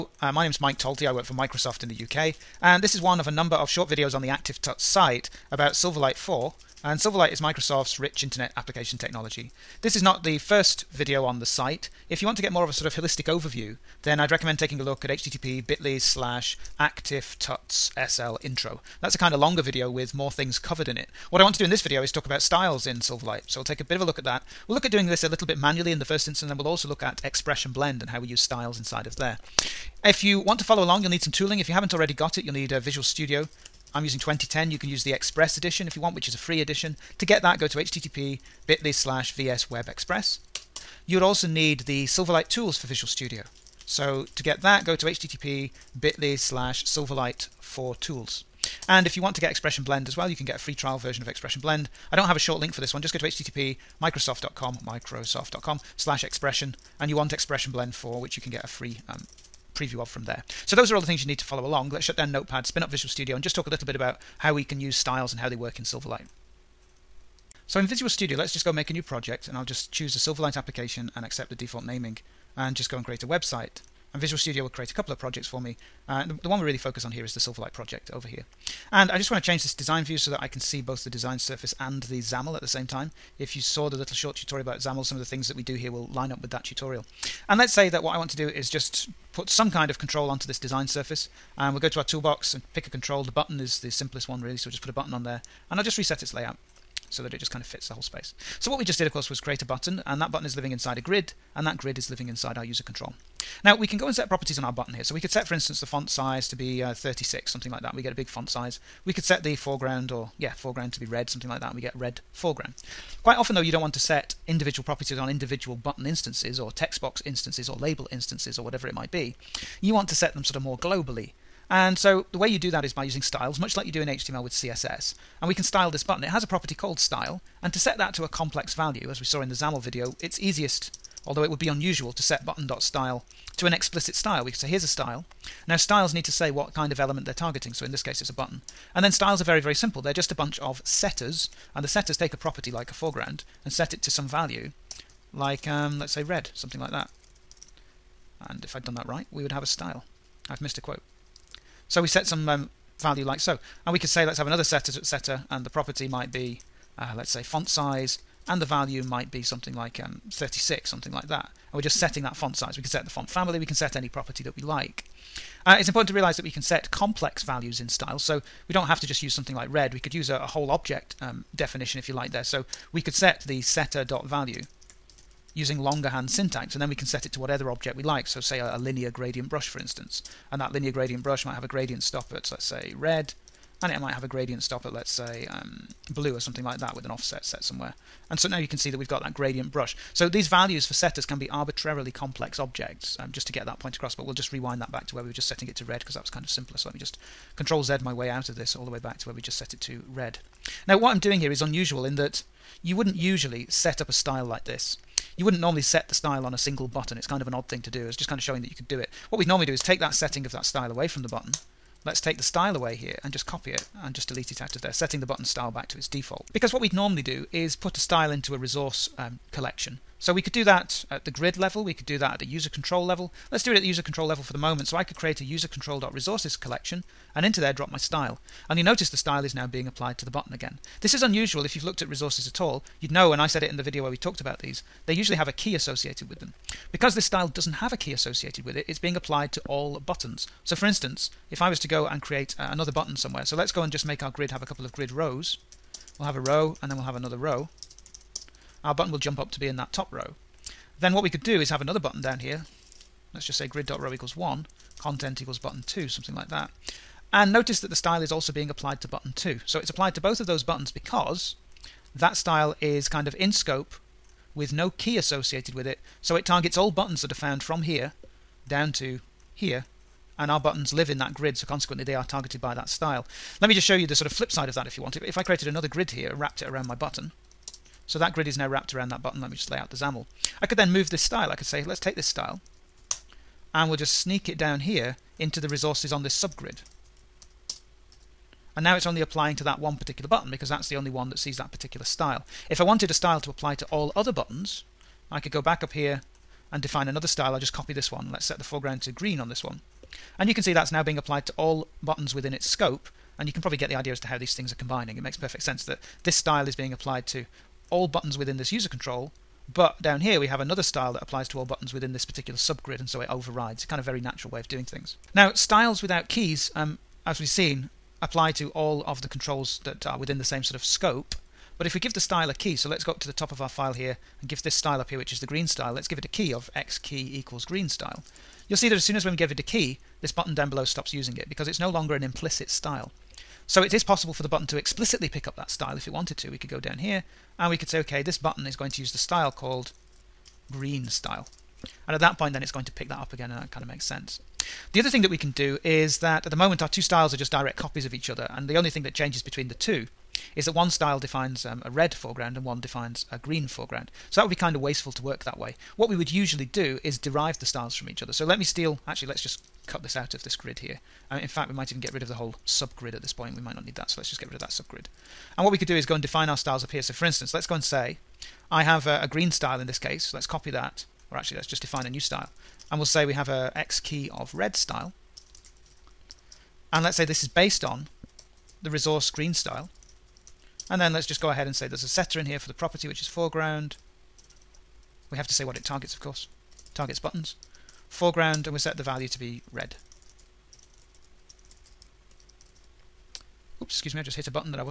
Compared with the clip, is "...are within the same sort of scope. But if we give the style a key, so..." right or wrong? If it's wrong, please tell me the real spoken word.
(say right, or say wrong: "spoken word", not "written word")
right.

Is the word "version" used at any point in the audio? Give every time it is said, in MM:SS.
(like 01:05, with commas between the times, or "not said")
00:50.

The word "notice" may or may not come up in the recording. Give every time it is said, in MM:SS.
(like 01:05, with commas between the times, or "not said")
03:48, 04:17.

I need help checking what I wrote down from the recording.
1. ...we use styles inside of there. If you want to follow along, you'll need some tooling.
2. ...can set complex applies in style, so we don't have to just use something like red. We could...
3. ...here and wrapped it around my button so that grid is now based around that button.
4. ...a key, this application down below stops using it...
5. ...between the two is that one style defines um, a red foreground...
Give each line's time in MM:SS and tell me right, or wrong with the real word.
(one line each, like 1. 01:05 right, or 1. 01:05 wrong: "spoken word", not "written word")
1. 00:28 right
2. 02:46 wrong: "values", not "applies"
3. 04:36 wrong: "wrapped", not "based"
4. 05:29 wrong: "button", not "application"
5. 05:49 right.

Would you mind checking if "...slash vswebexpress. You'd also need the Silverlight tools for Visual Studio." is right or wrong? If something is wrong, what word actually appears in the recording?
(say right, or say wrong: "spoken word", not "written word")
right.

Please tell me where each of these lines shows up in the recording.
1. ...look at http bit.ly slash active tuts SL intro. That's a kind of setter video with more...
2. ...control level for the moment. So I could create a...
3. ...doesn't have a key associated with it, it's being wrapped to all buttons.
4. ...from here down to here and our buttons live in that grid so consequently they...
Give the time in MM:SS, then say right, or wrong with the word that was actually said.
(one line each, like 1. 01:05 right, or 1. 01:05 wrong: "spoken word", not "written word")
1. 00:14 wrong: "longer", not "setter"
2. 03:44 right
3. 03:57 wrong: "applied", not "wrapped"
4. 04:27 right.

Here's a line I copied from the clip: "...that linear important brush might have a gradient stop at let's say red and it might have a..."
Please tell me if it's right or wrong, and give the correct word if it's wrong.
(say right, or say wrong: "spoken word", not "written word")
wrong: "gradient", not "important".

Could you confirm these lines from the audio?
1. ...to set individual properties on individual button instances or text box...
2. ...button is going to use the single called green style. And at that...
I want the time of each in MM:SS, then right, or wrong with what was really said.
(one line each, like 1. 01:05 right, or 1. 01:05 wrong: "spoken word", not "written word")
1. 01:53 right
2. 05:38 wrong: "style", not "single".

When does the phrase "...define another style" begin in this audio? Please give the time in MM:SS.
04:56.